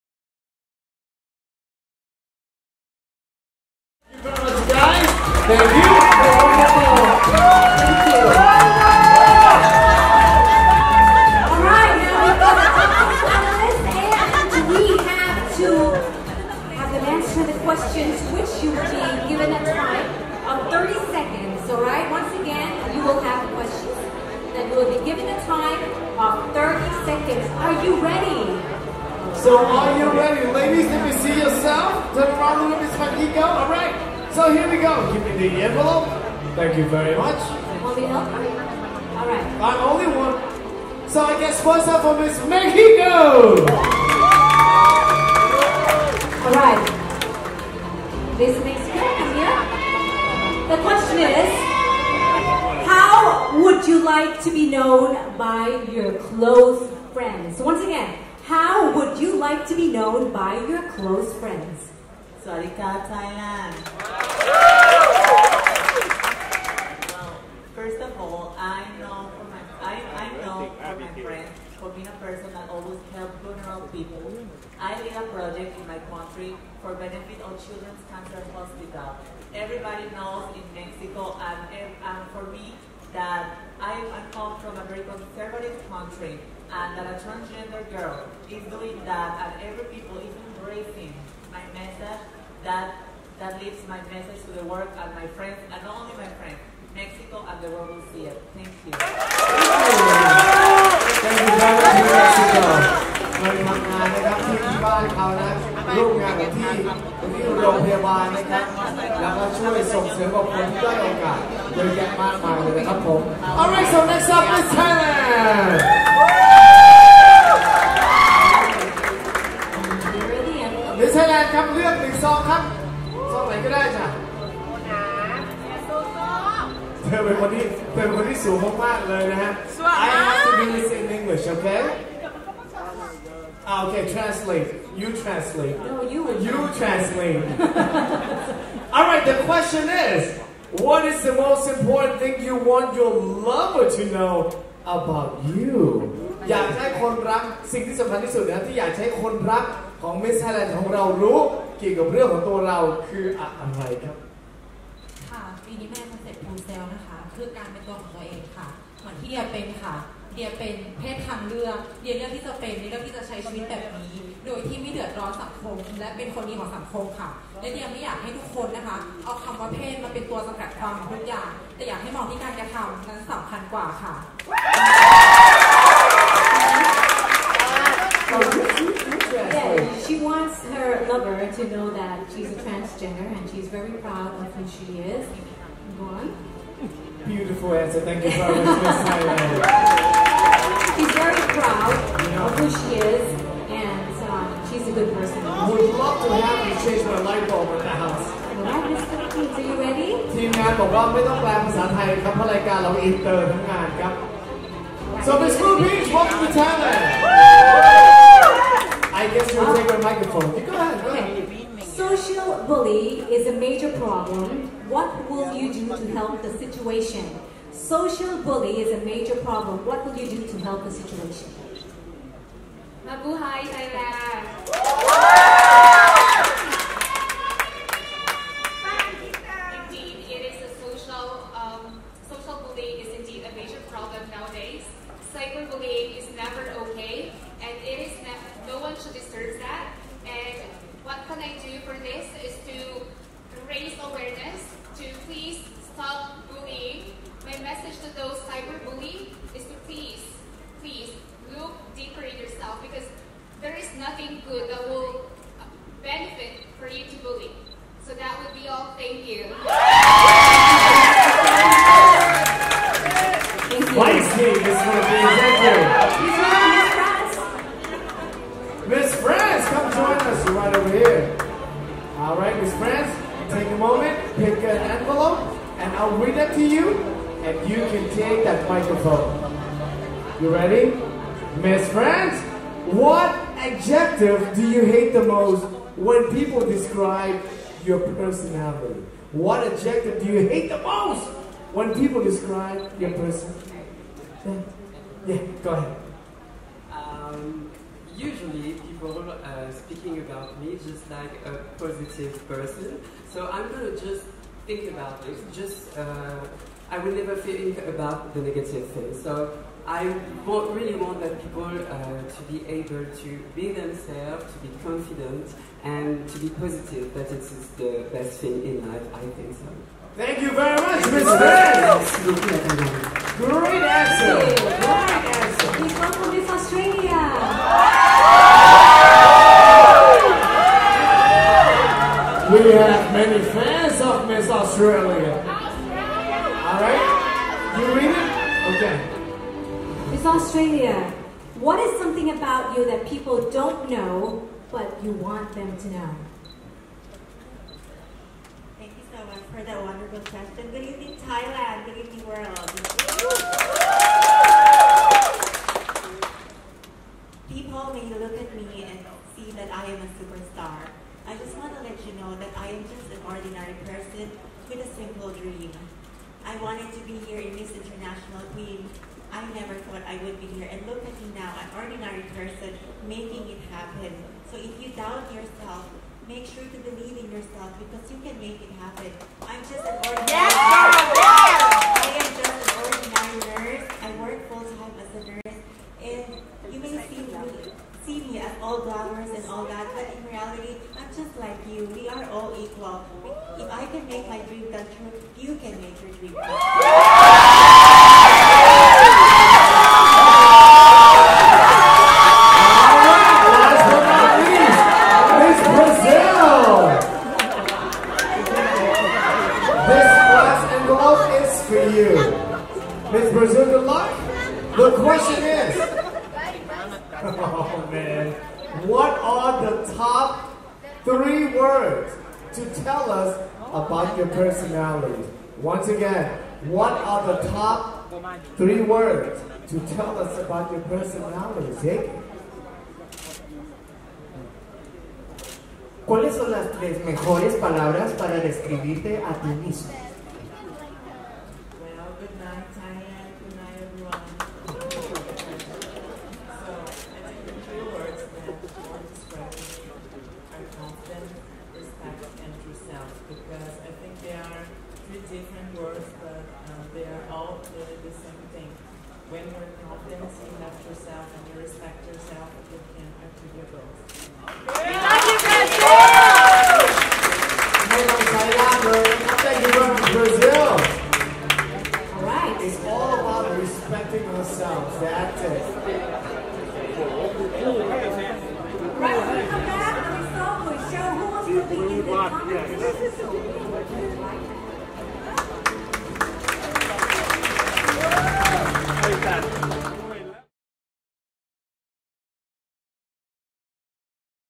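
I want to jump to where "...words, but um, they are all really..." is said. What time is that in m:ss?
7:35.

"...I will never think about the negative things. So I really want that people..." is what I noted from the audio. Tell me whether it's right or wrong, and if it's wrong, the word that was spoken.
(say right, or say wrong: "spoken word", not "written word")
right.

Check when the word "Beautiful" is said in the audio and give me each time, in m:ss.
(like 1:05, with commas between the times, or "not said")
3:07.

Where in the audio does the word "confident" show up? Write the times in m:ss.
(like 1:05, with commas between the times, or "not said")
5:14, 7:39.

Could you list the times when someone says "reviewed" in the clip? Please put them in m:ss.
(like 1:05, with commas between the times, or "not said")
not said.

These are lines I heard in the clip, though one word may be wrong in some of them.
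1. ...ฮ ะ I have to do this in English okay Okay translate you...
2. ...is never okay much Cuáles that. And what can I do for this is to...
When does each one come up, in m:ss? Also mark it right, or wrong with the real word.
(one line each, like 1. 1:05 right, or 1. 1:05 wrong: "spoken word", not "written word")
1. 2:09 right
2. 3:56 wrong: "deserves", not "Cuáles".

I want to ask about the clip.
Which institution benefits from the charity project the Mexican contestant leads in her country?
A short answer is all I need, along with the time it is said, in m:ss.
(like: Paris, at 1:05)
Children's Cancer Hospital, at 1:17.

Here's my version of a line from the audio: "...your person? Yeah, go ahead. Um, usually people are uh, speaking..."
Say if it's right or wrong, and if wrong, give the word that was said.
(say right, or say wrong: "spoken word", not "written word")
right.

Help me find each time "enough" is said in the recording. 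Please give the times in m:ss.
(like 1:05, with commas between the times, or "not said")
7:40.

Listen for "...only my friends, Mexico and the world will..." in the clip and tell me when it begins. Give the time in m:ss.
1:35.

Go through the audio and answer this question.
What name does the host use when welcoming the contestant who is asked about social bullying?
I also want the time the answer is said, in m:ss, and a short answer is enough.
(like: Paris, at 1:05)
Ruby, at 3:25.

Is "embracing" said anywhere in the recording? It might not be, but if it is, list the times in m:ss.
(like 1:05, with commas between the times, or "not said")
1:30.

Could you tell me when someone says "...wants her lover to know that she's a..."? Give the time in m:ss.
3:00.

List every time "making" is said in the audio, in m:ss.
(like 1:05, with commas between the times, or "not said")
6:13.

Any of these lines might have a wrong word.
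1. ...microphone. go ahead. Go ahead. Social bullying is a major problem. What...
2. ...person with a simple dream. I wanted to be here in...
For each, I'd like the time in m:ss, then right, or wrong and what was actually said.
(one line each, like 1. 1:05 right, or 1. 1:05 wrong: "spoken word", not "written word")
1. 3:30 right
2. 6:03 right.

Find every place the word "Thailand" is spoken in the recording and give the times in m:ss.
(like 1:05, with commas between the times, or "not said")
1:03, 3:26, 3:43, 5:51.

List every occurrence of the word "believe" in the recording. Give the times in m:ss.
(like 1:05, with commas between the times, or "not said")
6:16.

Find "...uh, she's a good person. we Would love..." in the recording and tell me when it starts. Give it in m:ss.
3:14.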